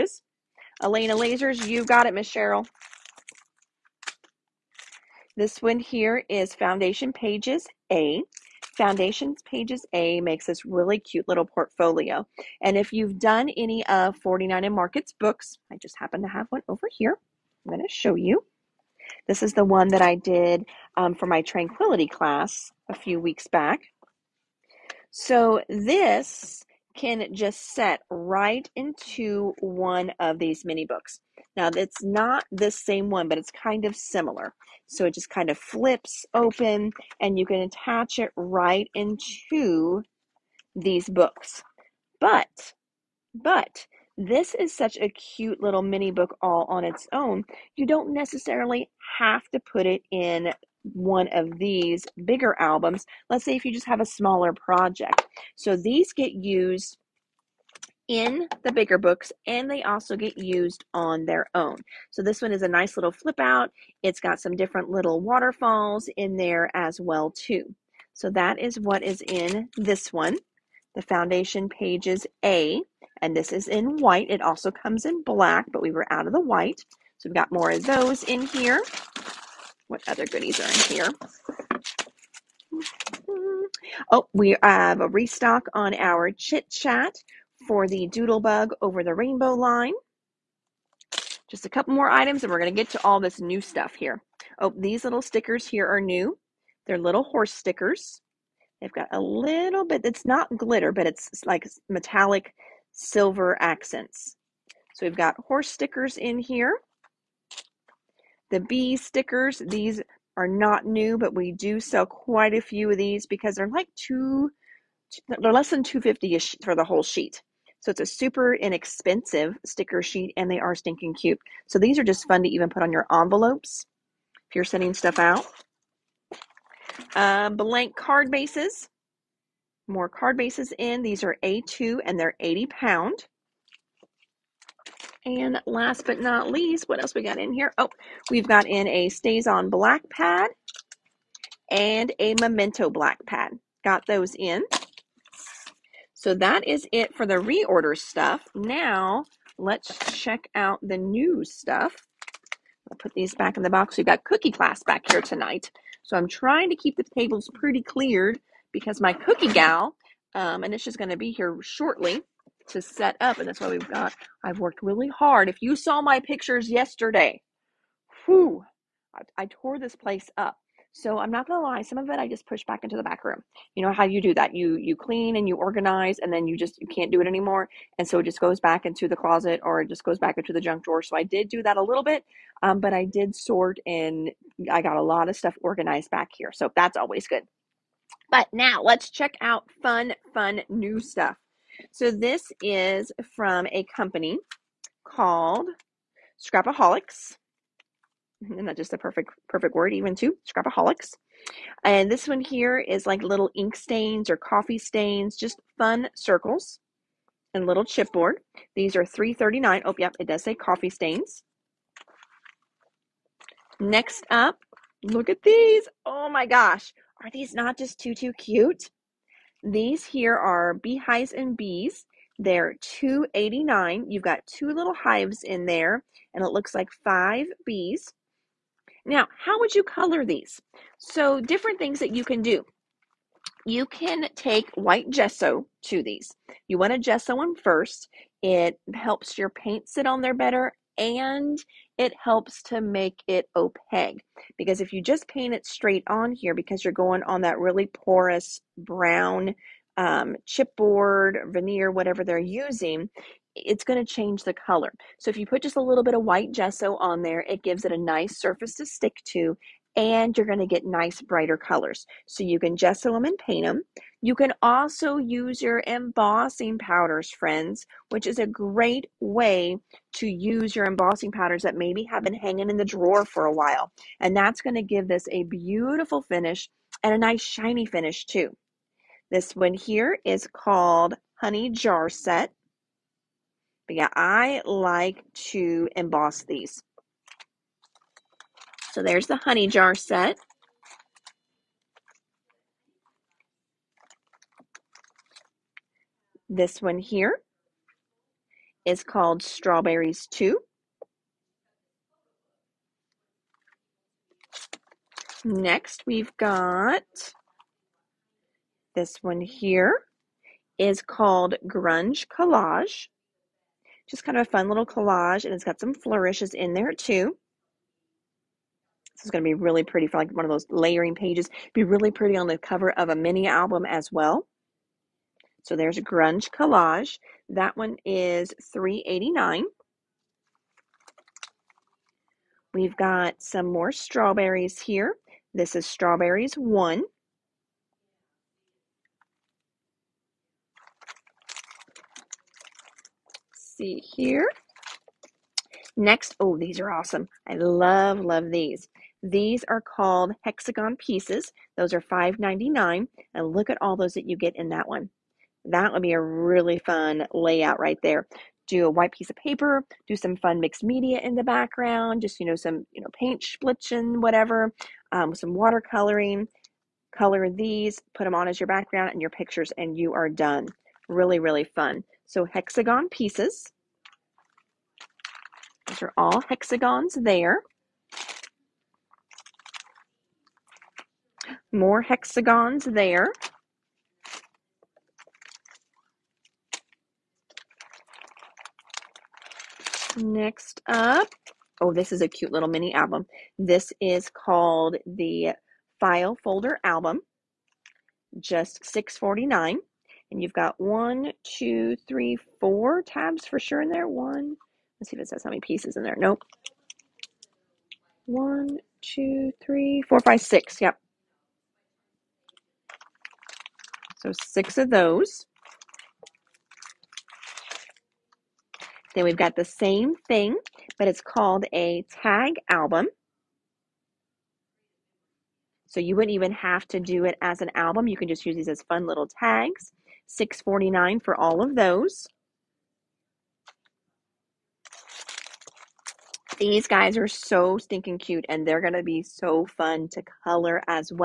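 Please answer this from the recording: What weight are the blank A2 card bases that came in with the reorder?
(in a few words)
80 pound.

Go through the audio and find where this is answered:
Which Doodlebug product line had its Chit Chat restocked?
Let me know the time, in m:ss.
1:28.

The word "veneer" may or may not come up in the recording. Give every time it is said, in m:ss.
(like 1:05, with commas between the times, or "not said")
4:11.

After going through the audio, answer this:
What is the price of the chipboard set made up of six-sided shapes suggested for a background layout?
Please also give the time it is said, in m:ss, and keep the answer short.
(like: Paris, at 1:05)
$5.99, at 5:52.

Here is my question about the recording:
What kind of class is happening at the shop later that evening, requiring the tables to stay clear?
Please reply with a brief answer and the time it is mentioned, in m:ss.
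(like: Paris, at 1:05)
Cookie class, at 2:34.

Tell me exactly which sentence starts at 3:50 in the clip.
So, different things that you can do.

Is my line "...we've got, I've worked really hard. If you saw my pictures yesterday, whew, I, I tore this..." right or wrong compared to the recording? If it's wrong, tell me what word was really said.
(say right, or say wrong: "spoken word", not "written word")
right.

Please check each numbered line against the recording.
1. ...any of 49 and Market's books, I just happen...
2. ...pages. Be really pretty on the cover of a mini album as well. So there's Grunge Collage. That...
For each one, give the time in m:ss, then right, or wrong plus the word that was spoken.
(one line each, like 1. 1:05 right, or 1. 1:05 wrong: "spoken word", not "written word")
1. 0:13 right
2. 5:21 right.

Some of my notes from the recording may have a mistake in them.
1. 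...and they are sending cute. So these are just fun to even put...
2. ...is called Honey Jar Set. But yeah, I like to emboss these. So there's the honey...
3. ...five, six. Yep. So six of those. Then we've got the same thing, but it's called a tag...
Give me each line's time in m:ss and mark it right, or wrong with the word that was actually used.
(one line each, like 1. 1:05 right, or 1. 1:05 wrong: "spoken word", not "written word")
1. 2:00 wrong: "stinking", not "sending"
2. 4:40 right
3. 6:50 right.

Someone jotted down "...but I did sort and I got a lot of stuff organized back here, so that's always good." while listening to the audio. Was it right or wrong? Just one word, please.
right.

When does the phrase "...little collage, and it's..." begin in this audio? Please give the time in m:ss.
5:14.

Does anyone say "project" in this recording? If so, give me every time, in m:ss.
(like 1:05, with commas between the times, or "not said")
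0:54.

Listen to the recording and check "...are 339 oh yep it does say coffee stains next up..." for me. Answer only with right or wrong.
right.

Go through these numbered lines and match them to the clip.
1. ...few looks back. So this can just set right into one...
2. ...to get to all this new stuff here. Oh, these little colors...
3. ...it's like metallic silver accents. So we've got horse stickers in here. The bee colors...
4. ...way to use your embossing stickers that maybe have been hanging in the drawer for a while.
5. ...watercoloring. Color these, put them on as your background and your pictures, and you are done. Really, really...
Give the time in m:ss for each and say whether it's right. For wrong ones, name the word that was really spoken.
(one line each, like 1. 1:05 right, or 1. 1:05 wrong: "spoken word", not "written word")
1. 0:22 wrong: "weeks", not "looks"
2. 1:32 wrong: "stickers", not "colors"
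3. 1:41 wrong: "stickers", not "colors"
4. 4:29 wrong: "powders", not "stickers"
5. 6:05 right.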